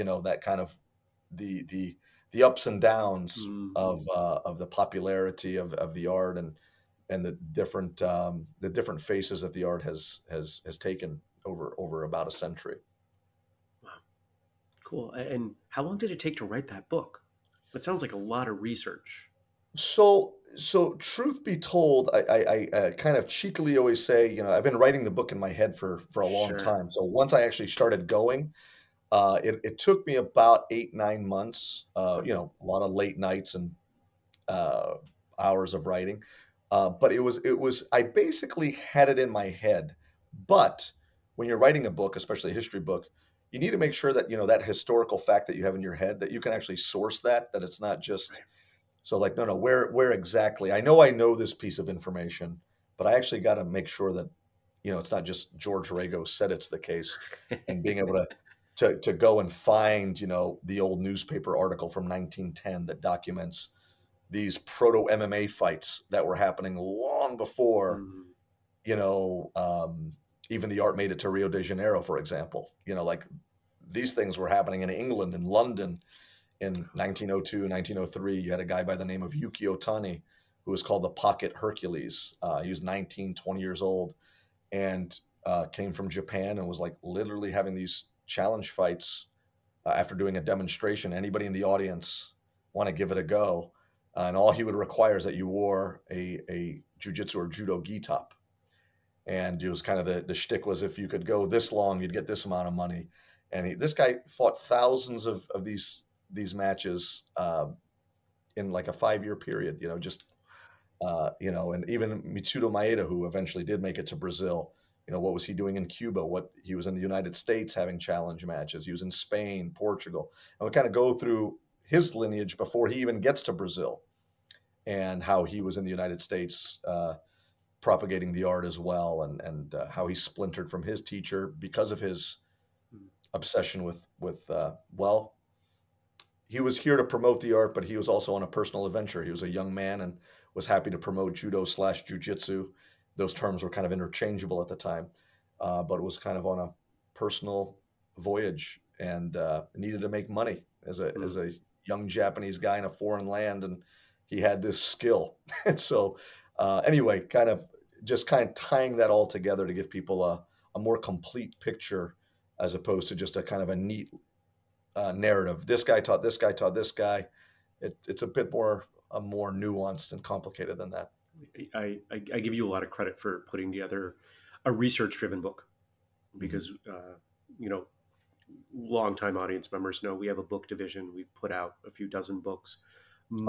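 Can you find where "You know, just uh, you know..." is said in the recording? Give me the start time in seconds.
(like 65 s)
109 s.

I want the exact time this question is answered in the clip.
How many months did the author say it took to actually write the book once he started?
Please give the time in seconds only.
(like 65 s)
30 s.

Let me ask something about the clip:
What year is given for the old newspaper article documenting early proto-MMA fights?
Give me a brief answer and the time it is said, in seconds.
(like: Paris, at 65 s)
1910, at 62 s.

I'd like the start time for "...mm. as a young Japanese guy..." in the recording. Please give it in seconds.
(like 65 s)
151 s.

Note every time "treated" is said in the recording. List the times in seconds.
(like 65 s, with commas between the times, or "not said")
not said.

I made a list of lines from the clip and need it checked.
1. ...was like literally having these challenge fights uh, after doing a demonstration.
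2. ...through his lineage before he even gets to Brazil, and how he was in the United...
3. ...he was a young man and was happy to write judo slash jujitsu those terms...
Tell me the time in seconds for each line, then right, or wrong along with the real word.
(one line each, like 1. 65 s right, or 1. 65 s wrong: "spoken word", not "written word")
1. 86 s right
2. 121 s right
3. 139 s wrong: "promote", not "write".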